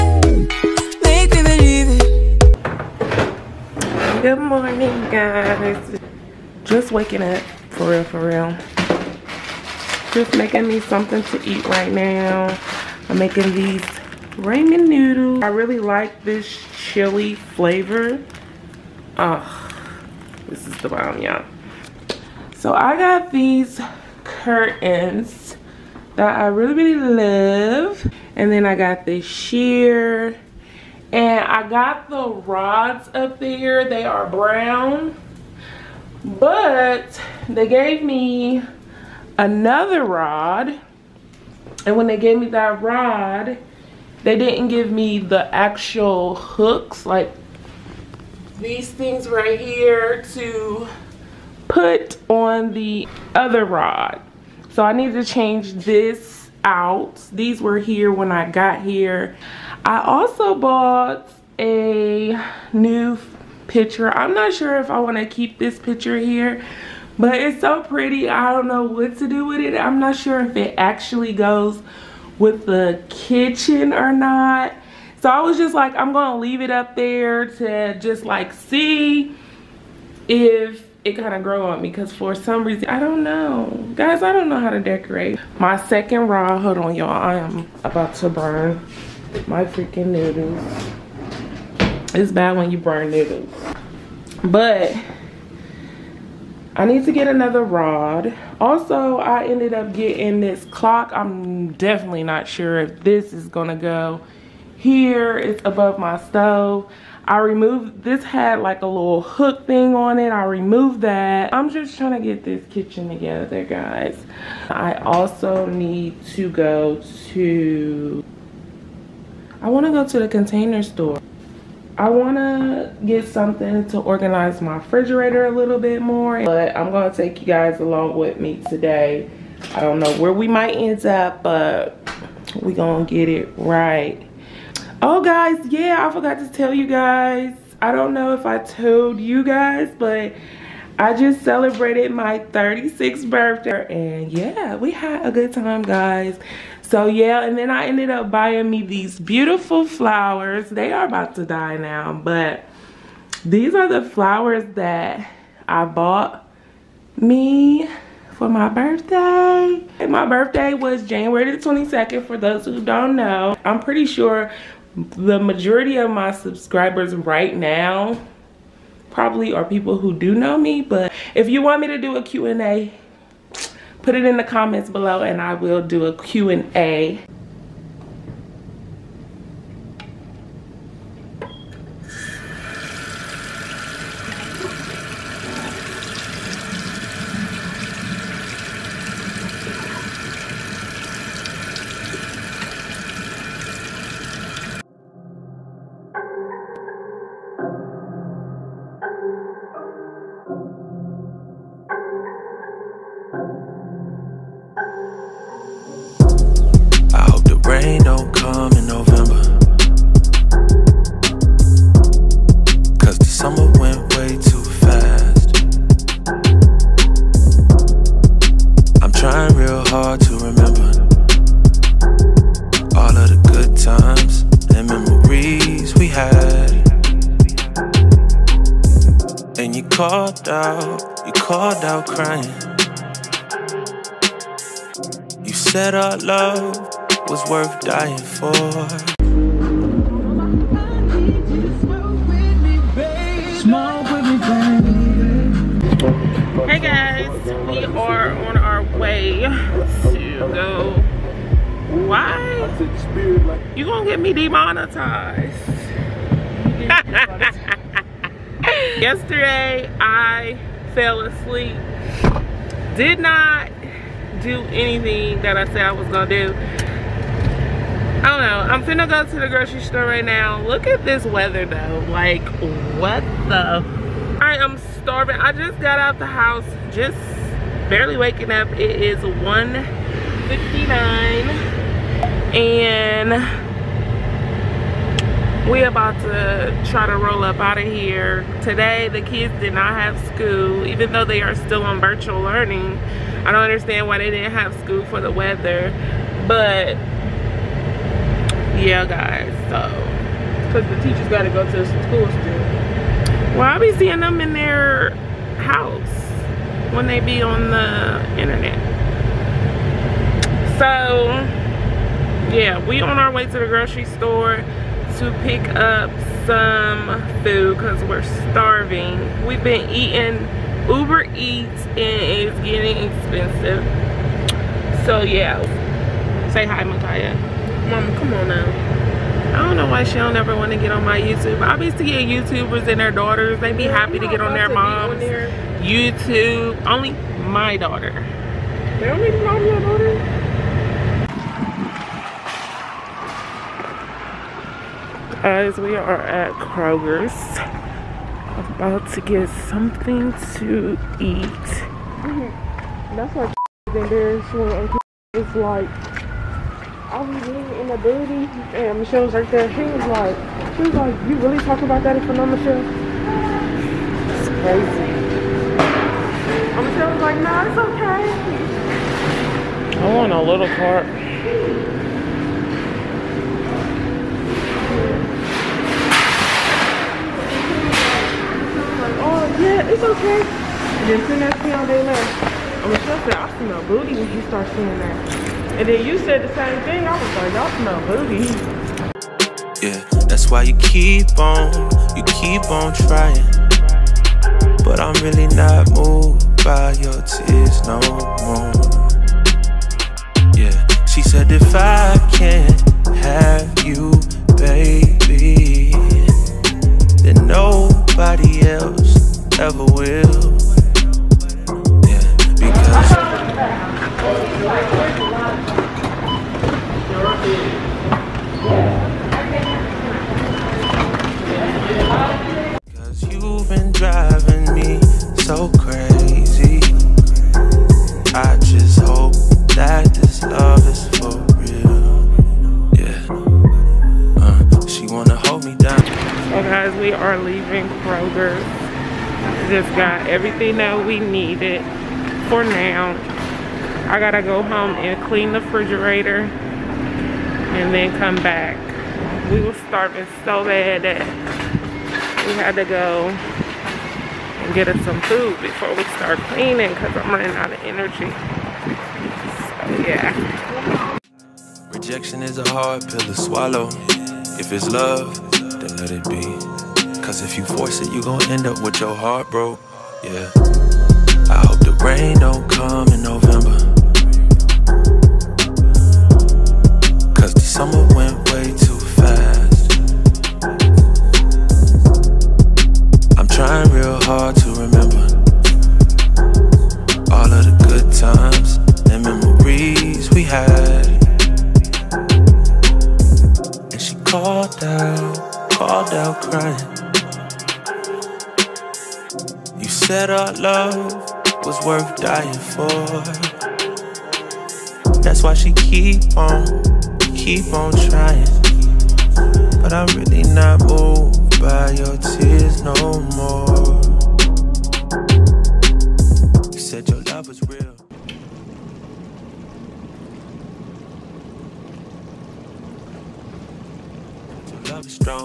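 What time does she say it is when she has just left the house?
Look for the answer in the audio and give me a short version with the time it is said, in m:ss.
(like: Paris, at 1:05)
1:59, at 4:39.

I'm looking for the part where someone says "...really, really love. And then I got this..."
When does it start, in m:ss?
0:26.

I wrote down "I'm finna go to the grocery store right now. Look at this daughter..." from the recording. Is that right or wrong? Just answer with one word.
wrong.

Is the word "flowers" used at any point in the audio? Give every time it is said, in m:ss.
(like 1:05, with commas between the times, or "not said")
2:29, 2:34.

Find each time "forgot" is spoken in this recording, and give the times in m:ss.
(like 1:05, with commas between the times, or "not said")
2:16.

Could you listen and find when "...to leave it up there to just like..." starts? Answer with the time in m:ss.
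1:16.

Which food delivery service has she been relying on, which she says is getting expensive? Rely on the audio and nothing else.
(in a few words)
Uber Eats.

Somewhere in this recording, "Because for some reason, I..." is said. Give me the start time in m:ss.
1:21.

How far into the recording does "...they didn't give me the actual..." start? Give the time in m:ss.
0:44.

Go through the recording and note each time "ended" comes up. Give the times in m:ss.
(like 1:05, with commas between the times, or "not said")
1:39, 2:27.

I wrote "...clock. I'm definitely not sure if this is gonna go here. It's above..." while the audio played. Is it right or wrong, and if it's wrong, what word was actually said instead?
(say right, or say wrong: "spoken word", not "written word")
right.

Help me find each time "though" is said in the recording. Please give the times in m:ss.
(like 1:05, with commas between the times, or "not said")
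4:31, 4:51.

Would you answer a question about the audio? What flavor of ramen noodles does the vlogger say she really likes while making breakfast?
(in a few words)
Chili.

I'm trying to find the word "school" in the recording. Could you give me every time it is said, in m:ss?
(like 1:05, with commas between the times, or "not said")
4:50, 4:54, 5:01.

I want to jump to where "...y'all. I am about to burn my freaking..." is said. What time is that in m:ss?
1:26.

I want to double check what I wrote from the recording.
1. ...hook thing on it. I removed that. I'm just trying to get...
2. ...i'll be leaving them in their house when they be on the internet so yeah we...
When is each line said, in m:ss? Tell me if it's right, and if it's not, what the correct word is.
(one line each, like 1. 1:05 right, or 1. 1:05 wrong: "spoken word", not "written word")
1. 1:49 right
2. 5:03 wrong: "seeing", not "leaving".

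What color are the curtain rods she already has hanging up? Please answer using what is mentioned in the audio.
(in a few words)
Brown.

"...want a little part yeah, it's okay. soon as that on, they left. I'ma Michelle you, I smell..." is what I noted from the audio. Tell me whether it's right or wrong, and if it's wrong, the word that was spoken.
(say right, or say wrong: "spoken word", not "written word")
right.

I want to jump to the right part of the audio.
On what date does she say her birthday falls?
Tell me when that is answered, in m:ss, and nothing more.
2:41.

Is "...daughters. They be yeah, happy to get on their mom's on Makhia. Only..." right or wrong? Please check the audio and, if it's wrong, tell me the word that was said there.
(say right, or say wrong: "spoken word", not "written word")
wrong: "YouTube", not "Makhia".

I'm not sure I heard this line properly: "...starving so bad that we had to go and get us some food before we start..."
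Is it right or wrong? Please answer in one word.
right.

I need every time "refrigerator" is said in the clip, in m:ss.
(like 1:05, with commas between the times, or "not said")
2:04, 7:25.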